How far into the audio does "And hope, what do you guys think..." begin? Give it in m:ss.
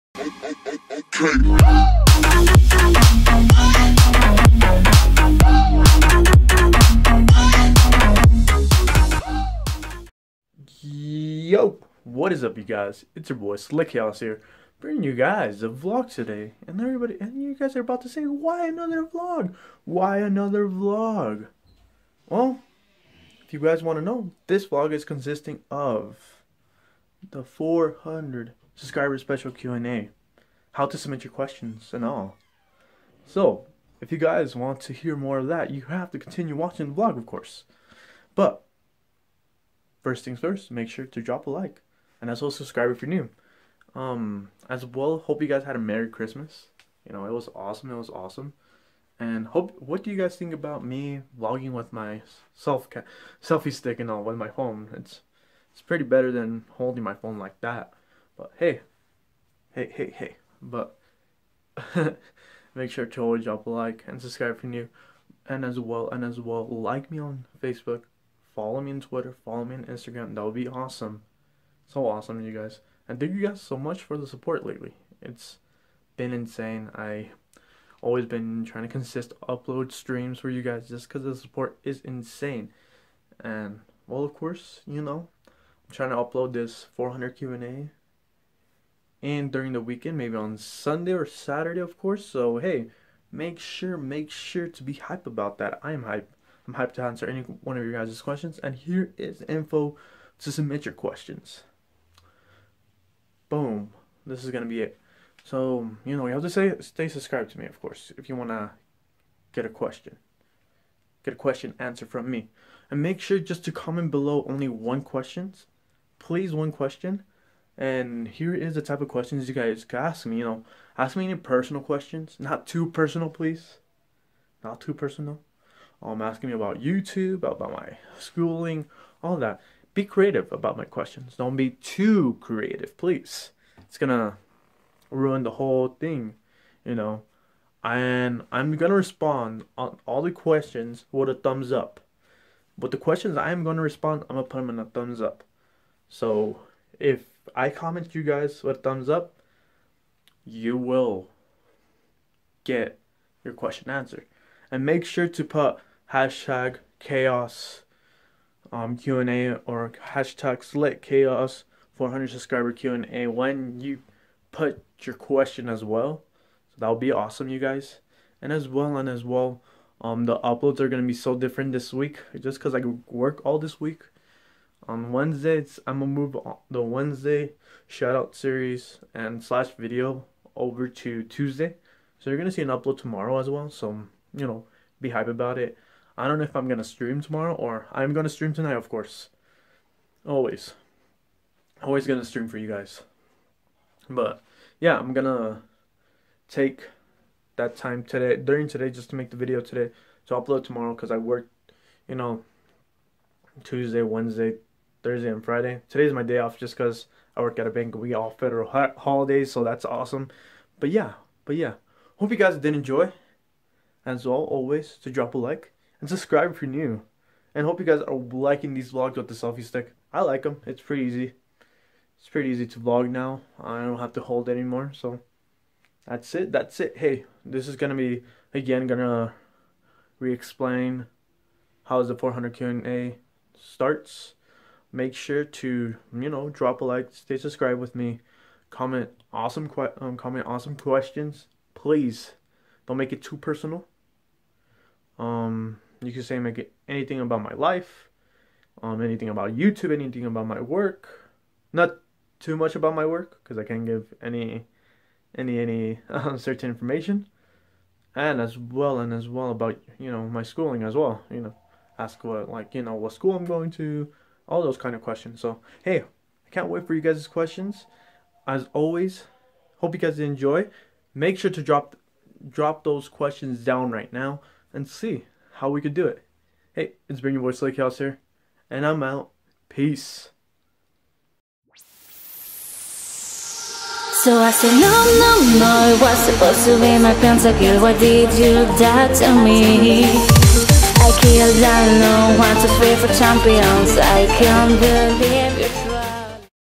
0:49.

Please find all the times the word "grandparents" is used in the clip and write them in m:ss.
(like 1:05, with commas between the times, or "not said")
not said.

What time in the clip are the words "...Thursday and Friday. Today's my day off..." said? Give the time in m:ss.
3:25.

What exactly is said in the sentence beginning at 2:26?
So if I comment you guys with thumbs up, you will get your question answered.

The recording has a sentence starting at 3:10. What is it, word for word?
Always, always gonna stream for you guys.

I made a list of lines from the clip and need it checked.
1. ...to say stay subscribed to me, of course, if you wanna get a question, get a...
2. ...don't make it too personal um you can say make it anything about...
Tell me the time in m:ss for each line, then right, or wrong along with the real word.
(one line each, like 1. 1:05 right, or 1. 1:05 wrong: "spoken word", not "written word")
1. 1:46 right
2. 4:02 right.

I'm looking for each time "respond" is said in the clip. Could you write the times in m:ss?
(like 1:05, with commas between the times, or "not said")
2:18, 2:23.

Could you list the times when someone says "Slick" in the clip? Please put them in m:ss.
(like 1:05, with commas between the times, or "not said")
0:13, 2:40, 4:37.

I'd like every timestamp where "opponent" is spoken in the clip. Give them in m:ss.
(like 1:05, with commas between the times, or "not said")
not said.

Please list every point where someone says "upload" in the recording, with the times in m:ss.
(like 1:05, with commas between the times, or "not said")
1:19, 1:26, 2:50, 3:02, 3:20.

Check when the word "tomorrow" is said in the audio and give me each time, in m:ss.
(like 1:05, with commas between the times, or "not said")
3:02, 3:07, 3:20.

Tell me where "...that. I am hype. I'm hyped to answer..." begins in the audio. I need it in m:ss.
1:35.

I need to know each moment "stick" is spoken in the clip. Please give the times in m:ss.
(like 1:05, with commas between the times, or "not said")
0:53, 3:39.